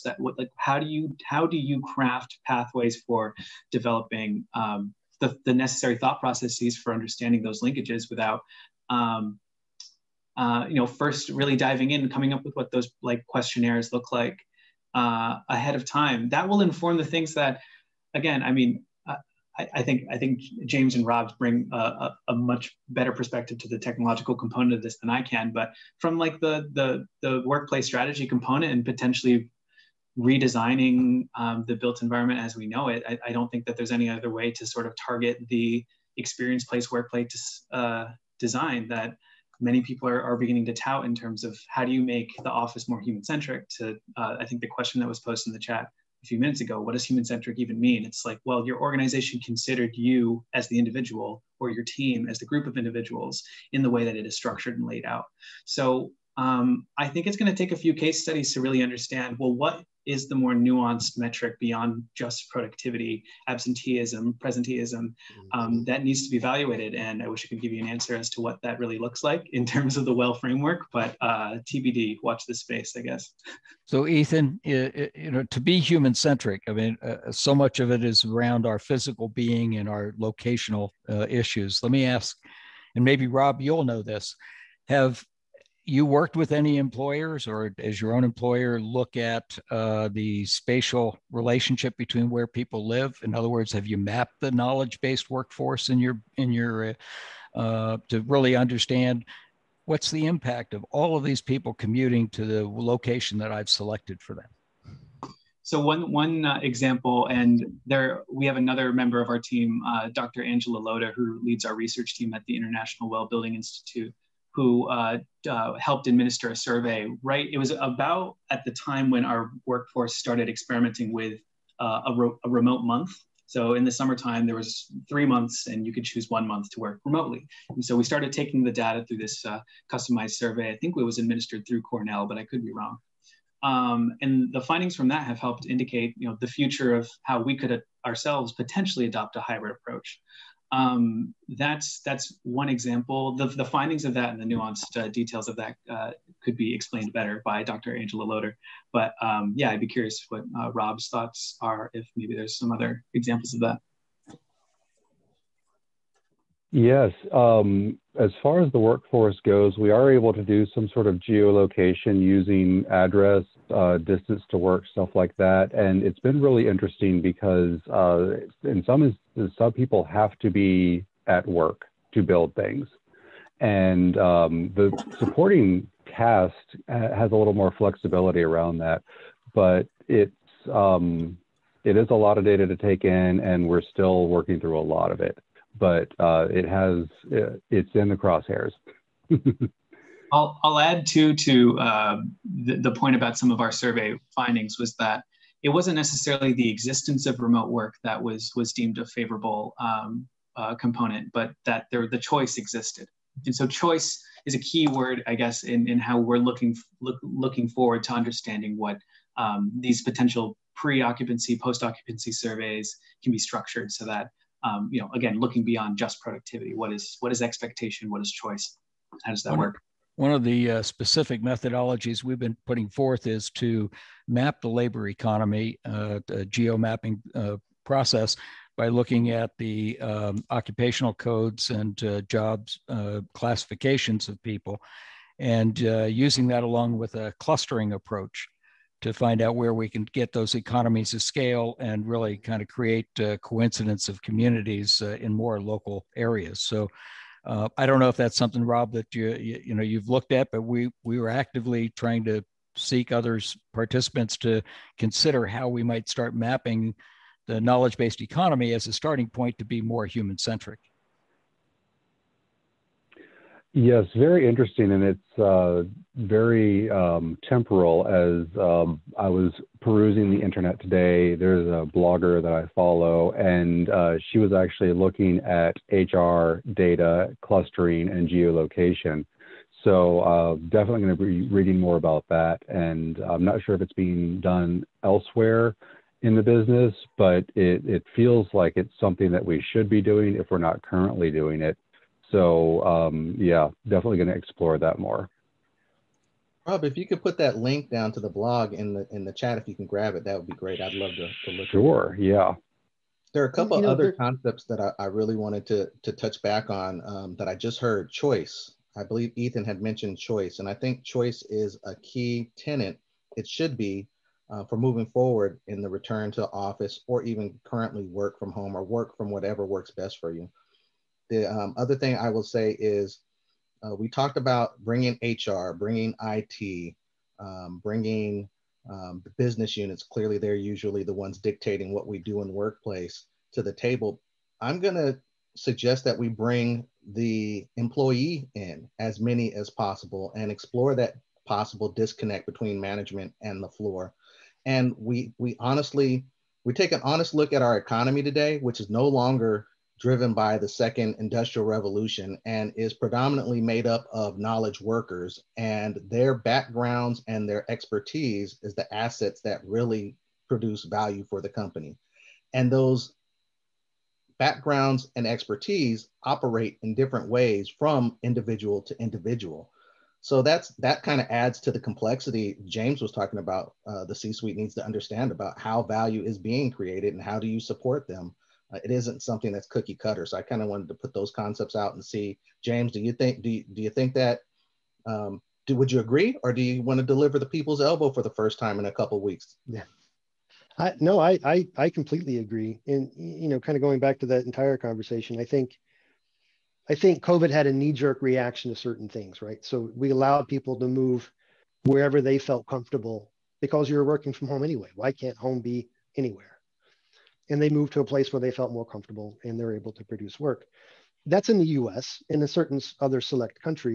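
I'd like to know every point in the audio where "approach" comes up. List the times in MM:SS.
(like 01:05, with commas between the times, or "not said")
02:19, 03:57.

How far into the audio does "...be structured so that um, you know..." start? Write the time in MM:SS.
03:33.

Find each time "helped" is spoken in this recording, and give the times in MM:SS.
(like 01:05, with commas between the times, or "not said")
01:55, 02:15.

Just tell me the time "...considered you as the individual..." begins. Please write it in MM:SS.
00:49.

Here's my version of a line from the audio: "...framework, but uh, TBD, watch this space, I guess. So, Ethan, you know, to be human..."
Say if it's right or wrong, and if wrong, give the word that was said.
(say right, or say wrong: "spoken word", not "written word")
right.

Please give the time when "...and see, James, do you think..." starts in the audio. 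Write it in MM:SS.
06:21.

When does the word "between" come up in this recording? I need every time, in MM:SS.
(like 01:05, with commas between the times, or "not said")
01:31, 05:42.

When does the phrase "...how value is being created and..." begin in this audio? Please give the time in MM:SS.
06:15.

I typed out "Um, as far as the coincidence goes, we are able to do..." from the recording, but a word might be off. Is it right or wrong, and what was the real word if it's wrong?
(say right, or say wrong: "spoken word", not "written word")
wrong: "workforce", not "coincidence".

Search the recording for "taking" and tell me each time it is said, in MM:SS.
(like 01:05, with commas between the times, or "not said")
02:08.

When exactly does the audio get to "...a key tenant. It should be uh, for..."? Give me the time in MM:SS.
05:11.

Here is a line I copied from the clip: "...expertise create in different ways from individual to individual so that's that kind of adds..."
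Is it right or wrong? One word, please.
wrong.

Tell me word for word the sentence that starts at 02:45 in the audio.
And it's been really interesting because uh, in some instances, some people have to be at work to build things.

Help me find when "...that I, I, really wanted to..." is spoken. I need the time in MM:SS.
05:04.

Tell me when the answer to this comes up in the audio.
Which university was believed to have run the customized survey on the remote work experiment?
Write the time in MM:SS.
02:11.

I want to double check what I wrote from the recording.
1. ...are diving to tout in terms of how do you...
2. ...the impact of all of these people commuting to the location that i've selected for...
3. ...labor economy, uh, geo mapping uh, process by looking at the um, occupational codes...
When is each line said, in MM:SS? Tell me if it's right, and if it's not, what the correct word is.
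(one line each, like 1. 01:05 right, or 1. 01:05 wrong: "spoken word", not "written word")
1. 00:40 wrong: "beginning", not "diving"
2. 01:40 right
3. 03:44 right.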